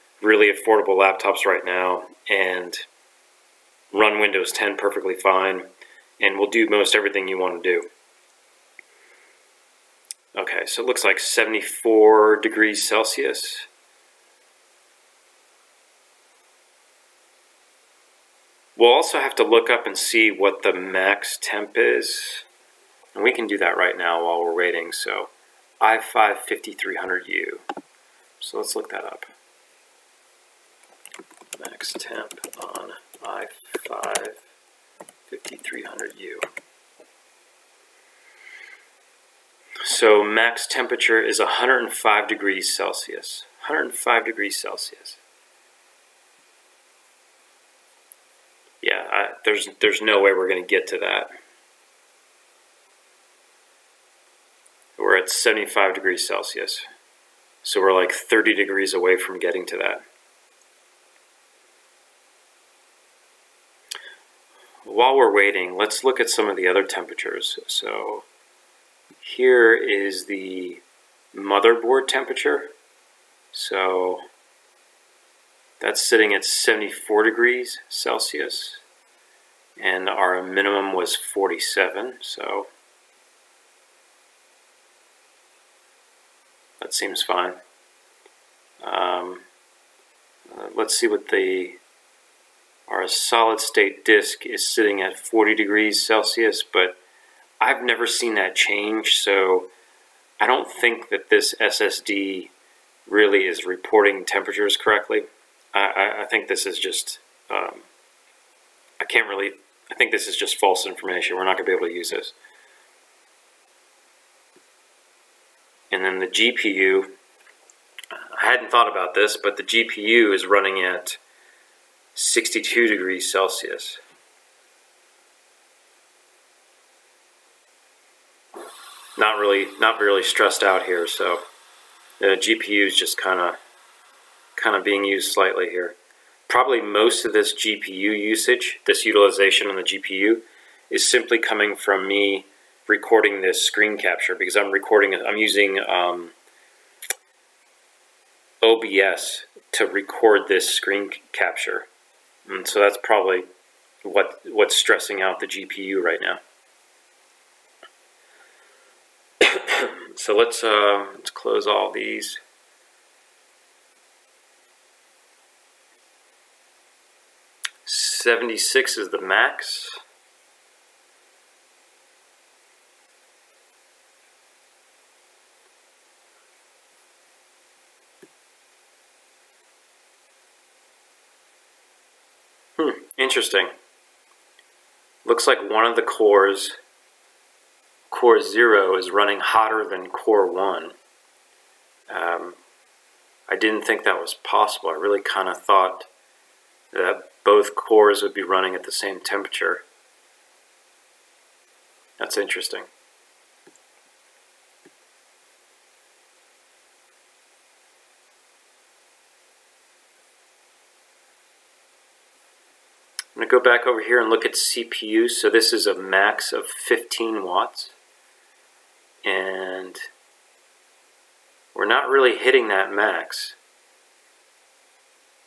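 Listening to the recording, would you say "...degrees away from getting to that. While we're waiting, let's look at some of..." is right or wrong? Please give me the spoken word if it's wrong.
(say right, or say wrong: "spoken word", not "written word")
right.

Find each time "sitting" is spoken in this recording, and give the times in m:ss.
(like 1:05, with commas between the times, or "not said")
1:16, 1:34.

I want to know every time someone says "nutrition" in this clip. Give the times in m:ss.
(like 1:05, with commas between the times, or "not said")
not said.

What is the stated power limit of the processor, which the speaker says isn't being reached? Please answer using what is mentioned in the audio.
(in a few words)
15 watts.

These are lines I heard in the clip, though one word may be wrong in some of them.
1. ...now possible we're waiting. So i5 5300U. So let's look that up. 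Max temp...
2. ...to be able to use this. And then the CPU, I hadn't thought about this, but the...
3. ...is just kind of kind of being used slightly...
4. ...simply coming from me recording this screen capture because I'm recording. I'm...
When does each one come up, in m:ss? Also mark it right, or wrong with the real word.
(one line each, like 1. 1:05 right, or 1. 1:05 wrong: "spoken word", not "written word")
1. 0:23 wrong: "while", not "possible"
2. 1:51 wrong: "GPU", not "CPU"
3. 2:12 right
4. 2:21 right.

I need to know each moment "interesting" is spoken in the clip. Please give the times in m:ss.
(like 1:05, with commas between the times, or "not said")
3:03, 3:22.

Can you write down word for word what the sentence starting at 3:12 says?
Um, I didn't think that was possible.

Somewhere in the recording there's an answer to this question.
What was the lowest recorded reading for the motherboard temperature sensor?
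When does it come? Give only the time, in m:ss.
1:21.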